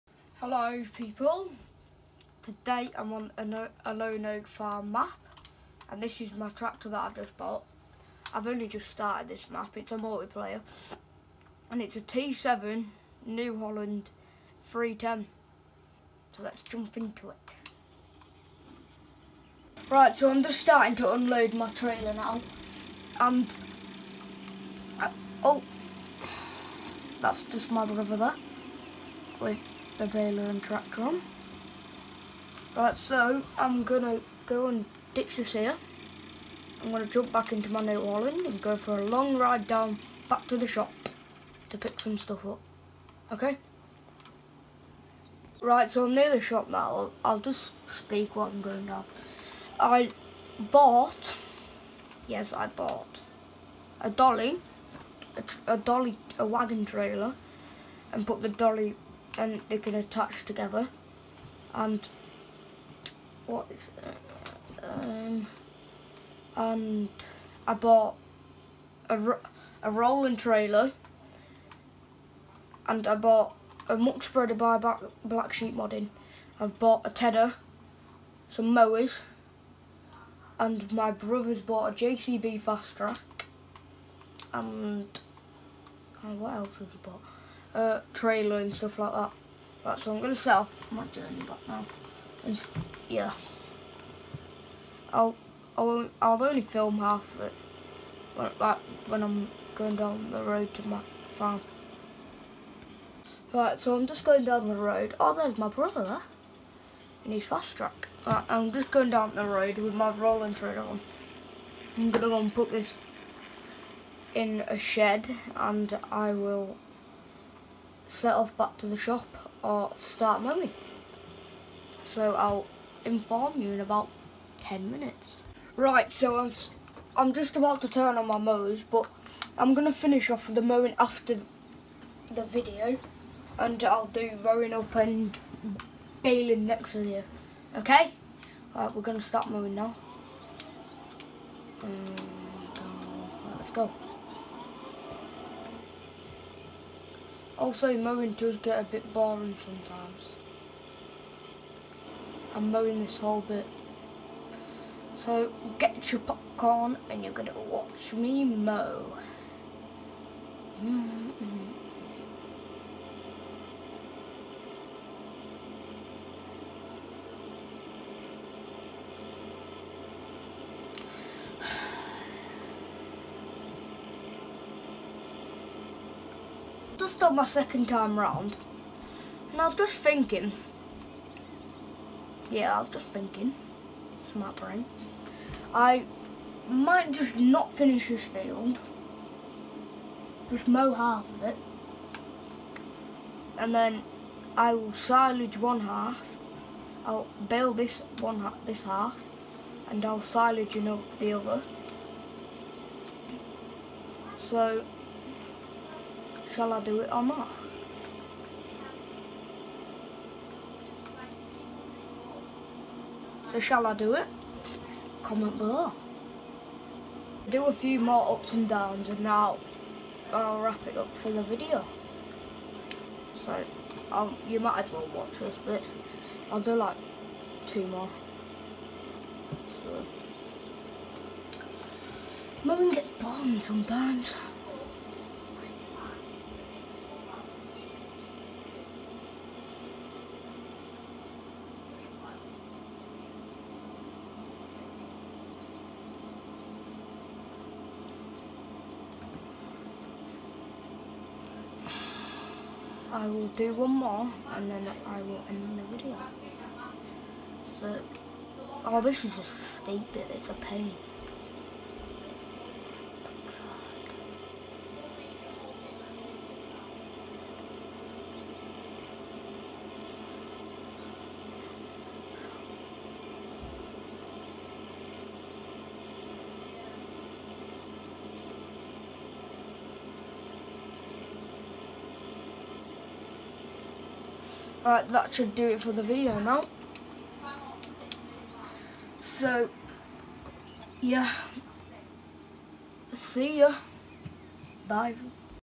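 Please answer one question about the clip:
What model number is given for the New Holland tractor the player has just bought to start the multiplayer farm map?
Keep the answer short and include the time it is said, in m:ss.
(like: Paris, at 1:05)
T7 310, at 0:12.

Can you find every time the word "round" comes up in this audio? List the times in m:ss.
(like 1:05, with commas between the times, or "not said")
2:58.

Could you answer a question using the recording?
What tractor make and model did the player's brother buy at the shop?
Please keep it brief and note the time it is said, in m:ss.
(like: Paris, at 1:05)
JCB Fastrac, at 1:22.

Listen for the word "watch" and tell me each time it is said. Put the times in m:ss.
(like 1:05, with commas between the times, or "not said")
2:37, 3:45.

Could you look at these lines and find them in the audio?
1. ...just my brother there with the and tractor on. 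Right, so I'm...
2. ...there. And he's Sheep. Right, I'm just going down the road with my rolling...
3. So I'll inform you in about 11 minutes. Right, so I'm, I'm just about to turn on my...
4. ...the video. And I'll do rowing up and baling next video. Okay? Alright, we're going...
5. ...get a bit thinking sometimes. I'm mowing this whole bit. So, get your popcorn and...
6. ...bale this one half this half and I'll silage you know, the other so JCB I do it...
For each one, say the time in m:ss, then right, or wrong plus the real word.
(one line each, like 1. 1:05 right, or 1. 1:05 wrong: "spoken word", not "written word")
1. 0:27 right
2. 1:46 wrong: "Fastrac", not "Sheep"
3. 2:02 wrong: "10", not "11"
4. 2:12 right
5. 2:28 wrong: "boring", not "thinking"
6. 3:17 wrong: "Shall", not "JCB".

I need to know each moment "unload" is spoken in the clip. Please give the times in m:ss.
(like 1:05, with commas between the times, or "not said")
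0:21.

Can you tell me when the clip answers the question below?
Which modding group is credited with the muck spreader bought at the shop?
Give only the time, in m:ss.
1:15.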